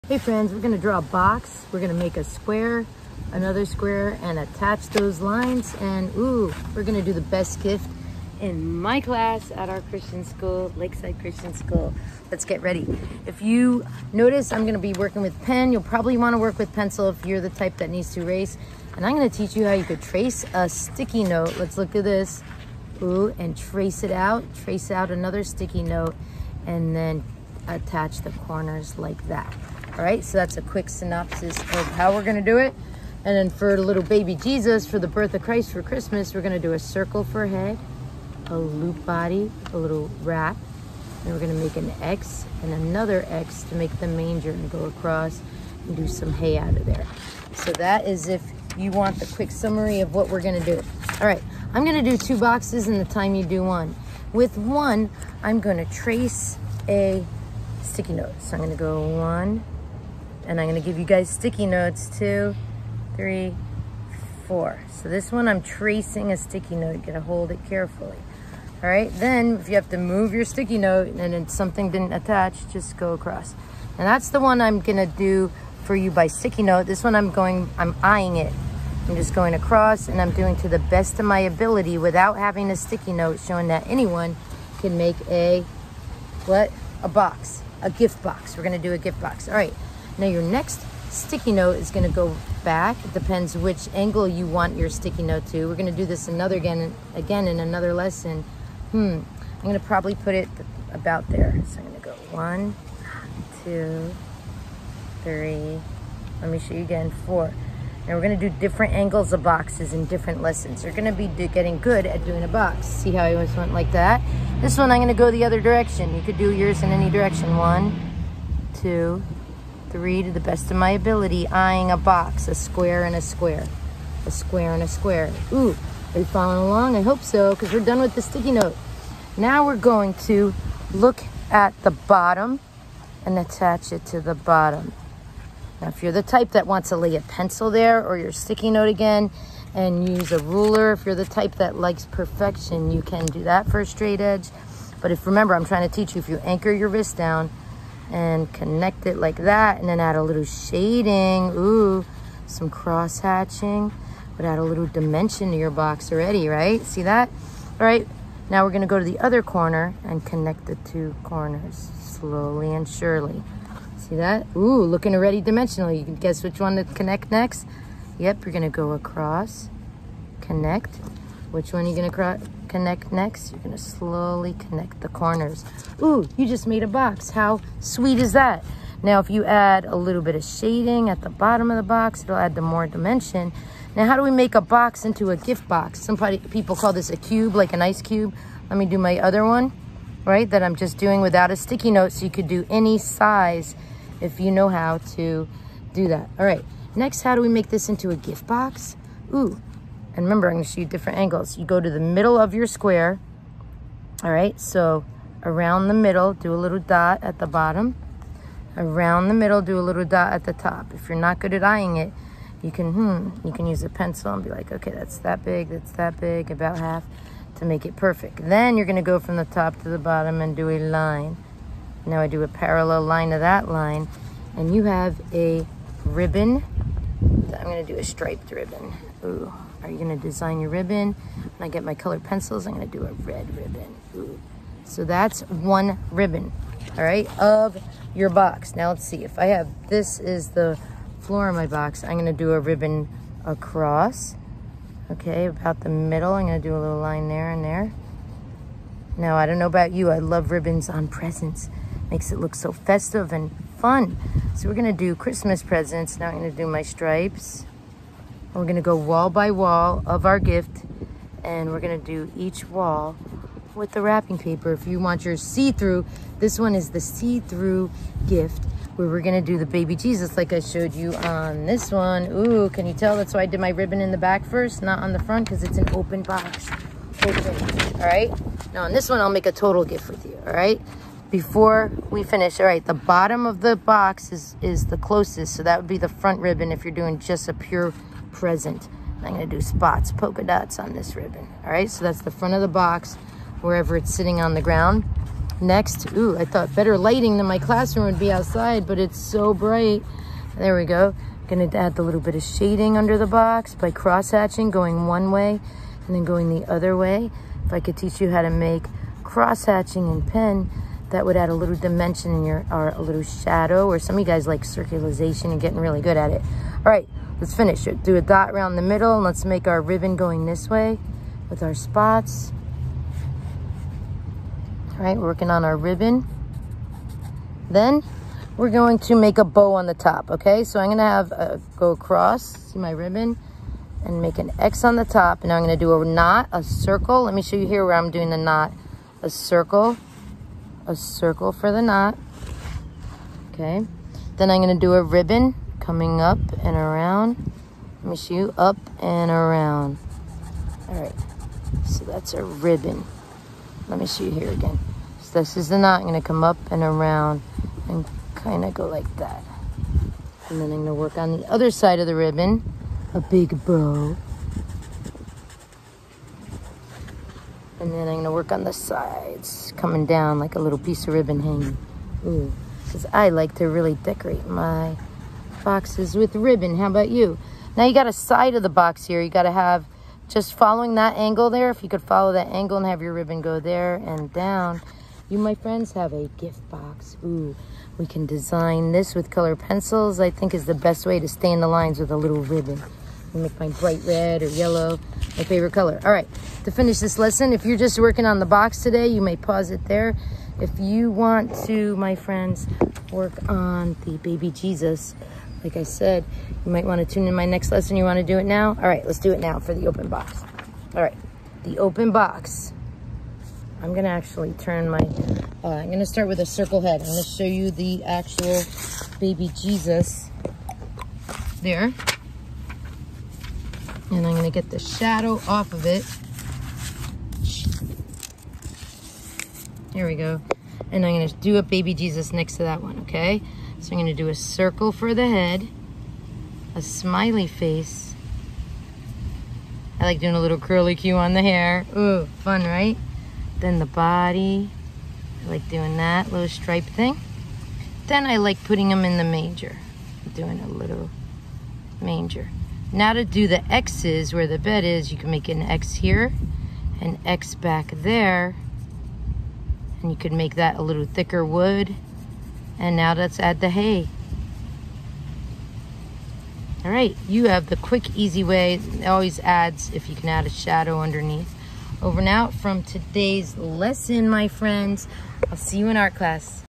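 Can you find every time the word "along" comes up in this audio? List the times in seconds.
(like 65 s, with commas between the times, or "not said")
126 s.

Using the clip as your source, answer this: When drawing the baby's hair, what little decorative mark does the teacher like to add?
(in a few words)
curly cue.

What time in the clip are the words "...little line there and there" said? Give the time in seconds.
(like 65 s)
246 s.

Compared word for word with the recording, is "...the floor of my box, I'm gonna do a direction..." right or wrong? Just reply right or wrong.
wrong.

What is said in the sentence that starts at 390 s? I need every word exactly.
I think is the best way to stay in the lines with a little ribbon.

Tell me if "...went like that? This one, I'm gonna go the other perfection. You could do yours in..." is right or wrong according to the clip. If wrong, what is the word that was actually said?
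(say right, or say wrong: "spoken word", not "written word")
wrong: "direction", not "perfection".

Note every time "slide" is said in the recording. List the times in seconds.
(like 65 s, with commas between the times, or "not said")
not said.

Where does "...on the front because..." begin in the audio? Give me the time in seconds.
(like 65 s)
274 s.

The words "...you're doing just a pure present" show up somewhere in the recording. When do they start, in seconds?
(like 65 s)
286 s.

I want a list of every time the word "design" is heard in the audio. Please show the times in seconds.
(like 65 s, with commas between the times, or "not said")
230 s, 388 s.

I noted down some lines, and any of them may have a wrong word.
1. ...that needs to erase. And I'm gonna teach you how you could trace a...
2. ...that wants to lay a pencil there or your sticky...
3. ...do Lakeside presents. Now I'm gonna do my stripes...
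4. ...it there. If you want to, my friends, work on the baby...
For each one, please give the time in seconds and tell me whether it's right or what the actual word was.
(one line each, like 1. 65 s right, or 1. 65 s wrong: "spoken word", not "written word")
1. 17 s right
2. 136 s right
3. 254 s wrong: "Christmas", not "Lakeside"
4. 399 s right.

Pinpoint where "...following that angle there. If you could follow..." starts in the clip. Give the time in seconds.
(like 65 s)
380 s.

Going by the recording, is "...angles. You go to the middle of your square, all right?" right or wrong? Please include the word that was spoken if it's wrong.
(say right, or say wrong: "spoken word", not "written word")
right.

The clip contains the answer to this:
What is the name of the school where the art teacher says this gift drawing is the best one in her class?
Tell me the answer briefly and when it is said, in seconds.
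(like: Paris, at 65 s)
Lakeside Christian School, at 10 s.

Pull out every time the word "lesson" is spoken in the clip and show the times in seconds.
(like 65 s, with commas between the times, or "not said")
97 s, 110 s, 397 s, 407 s, 473 s.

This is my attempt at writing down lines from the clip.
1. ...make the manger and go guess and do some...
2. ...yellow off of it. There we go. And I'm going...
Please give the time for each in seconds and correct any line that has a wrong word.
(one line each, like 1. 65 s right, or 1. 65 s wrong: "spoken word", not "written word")
1. 43 s wrong: "across", not "guess"
2. 424 s wrong: "shadow", not "yellow".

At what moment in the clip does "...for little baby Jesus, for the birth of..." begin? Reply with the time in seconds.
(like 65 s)
33 s.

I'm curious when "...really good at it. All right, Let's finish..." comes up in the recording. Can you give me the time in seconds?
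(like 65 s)
315 s.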